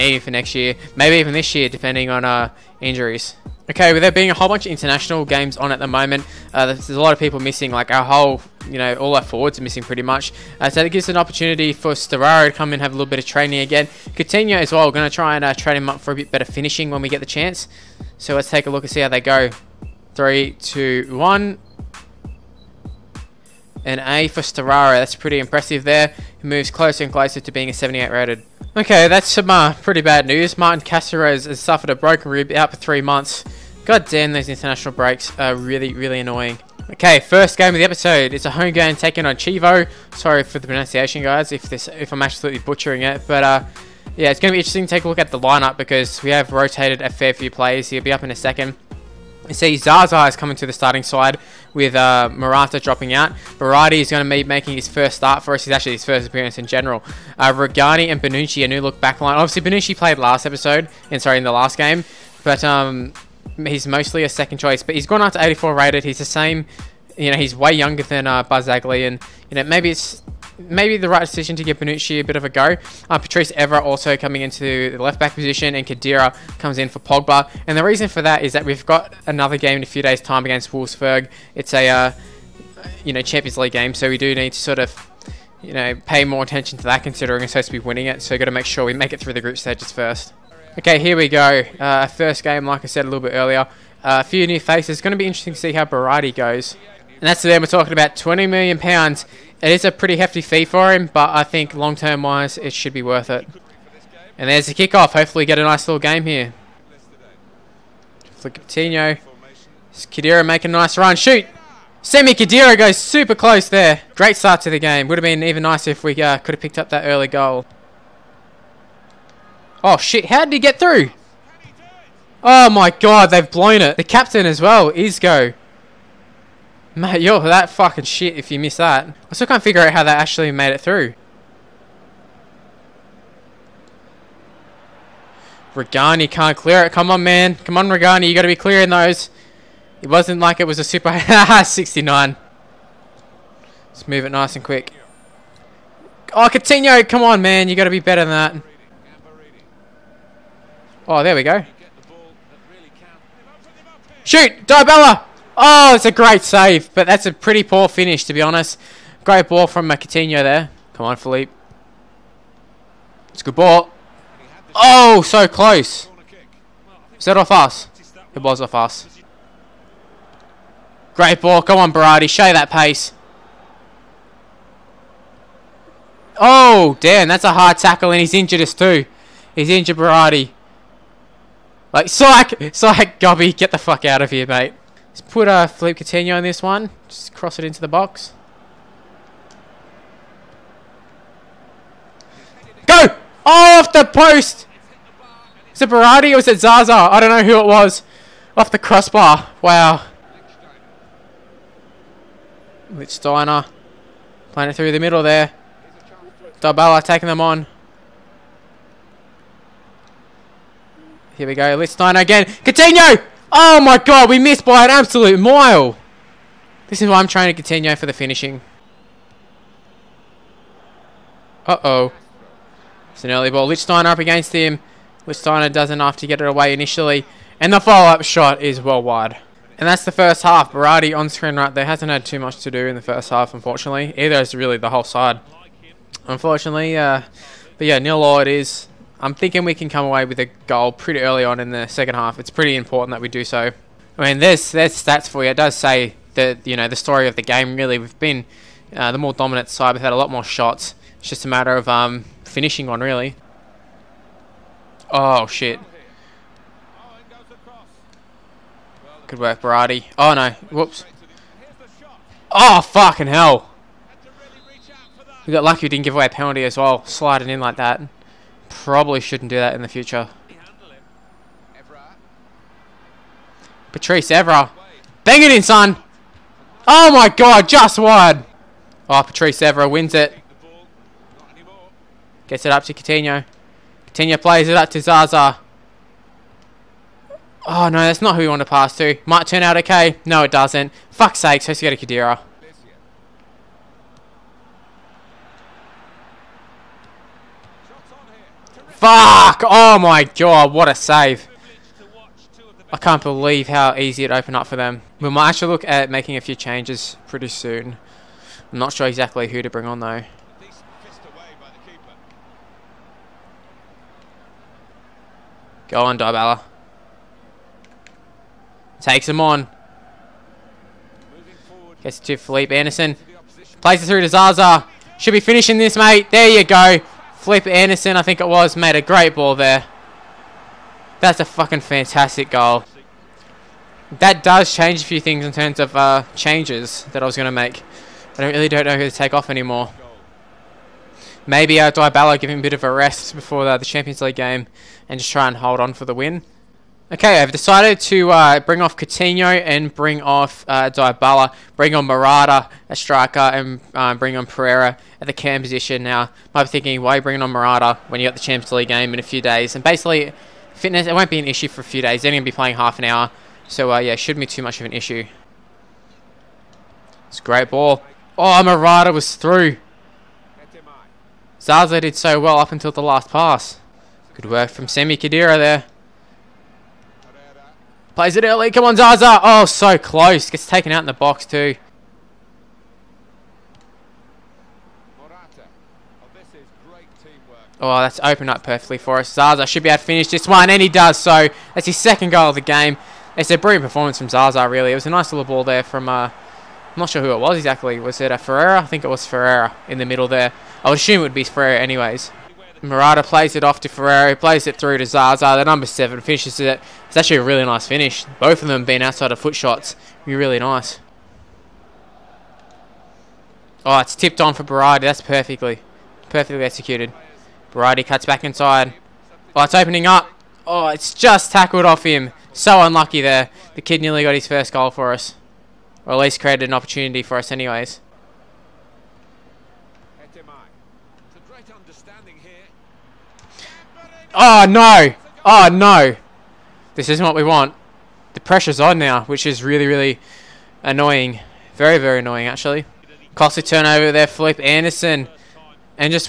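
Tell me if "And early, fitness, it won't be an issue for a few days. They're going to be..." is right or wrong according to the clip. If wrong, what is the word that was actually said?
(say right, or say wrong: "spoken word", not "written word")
wrong: "basically", not "early".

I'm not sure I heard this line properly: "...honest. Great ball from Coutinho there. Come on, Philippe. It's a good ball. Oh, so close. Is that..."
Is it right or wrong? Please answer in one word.
right.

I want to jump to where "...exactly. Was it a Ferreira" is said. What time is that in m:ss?
6:37.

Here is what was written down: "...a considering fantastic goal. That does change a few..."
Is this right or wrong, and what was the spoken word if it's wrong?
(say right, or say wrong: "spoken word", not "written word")
wrong: "fucking", not "considering".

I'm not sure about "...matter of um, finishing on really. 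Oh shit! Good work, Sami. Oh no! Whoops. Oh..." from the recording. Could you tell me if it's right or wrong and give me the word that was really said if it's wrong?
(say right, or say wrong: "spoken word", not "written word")
wrong: "Berardi", not "Sami".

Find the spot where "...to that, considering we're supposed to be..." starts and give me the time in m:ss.
1:26.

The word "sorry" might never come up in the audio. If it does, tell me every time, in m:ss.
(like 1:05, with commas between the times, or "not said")
0:40, 1:01.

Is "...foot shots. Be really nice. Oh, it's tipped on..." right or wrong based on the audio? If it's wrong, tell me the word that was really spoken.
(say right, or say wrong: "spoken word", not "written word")
right.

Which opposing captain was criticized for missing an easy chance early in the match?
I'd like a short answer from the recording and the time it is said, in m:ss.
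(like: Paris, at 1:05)
Isco, at 2:04.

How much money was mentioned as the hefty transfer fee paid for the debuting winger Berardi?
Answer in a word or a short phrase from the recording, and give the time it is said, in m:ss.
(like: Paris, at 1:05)
£20 million, at 1:38.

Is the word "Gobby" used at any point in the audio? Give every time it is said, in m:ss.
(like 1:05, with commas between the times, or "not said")
3:03.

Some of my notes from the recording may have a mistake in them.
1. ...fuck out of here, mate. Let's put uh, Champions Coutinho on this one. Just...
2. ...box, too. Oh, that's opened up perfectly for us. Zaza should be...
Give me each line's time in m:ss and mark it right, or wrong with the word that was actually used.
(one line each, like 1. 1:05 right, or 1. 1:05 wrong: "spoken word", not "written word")
1. 3:03 wrong: "Philippe", not "Champions"
2. 6:21 right.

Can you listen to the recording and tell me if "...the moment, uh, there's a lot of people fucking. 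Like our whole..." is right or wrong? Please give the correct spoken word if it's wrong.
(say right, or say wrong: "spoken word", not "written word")
wrong: "missing", not "fucking".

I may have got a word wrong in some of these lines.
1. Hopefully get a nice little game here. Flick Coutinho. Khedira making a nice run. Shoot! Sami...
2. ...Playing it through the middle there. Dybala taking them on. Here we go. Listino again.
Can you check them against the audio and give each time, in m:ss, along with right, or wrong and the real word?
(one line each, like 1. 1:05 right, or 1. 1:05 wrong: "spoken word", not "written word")
1. 1:45 right
2. 3:24 right.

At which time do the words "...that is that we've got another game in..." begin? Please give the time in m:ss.
1:18.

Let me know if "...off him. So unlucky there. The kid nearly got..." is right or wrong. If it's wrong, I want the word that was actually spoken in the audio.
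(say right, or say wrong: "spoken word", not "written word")
right.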